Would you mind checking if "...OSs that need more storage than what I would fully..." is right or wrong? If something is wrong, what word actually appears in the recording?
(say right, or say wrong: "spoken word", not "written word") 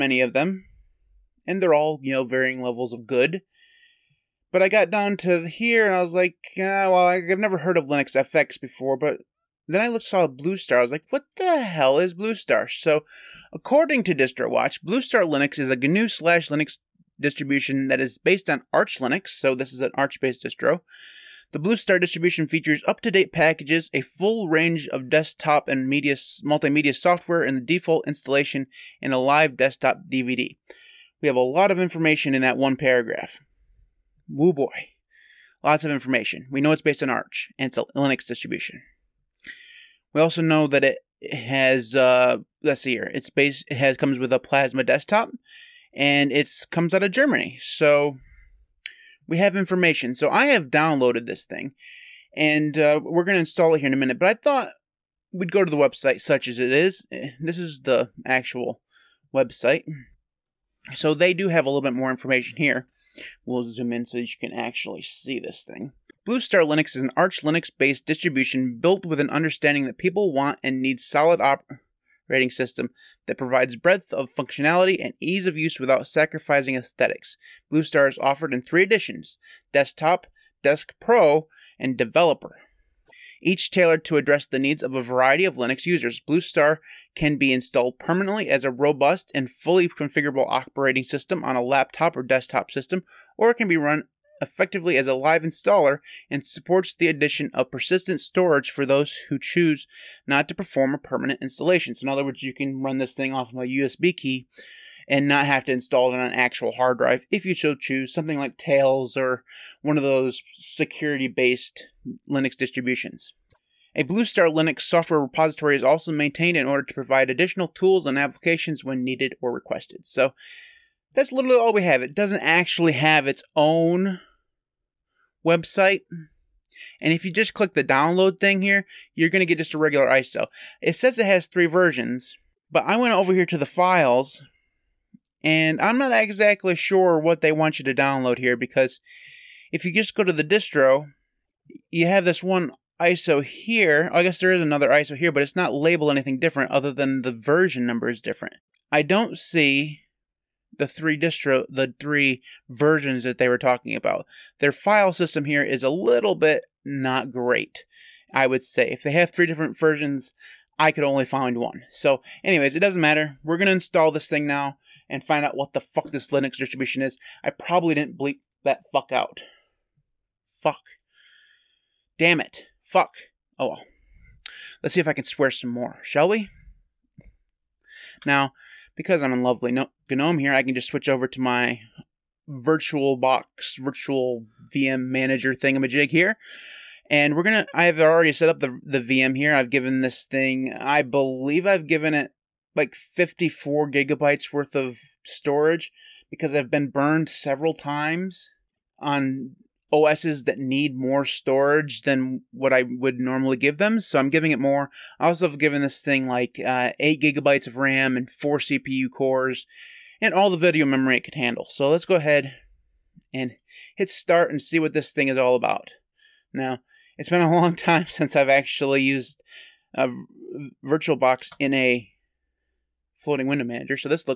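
wrong: "normally", not "fully".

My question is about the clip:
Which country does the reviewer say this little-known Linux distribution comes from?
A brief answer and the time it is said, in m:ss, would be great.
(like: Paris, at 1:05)
Germany, at 0:47.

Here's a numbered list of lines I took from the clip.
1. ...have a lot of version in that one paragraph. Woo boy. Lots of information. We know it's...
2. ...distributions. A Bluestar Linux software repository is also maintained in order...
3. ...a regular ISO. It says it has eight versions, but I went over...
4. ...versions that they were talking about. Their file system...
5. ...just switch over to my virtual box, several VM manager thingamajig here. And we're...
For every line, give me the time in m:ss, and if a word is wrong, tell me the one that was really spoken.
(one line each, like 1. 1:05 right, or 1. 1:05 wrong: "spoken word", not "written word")
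1. 0:31 wrong: "information", not "version"
2. 1:52 right
3. 2:09 wrong: "three", not "eight"
4. 2:32 right
5. 3:00 wrong: "virtual", not "several".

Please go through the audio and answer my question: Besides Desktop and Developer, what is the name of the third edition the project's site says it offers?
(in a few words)
Desk Pro.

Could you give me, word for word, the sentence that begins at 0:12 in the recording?
So, according to DistroWatch, Blue Star Linux is a GNU slash Linux distribution that is based on Arch Linux.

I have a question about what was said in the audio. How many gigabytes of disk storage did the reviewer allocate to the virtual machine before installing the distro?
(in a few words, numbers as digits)
54.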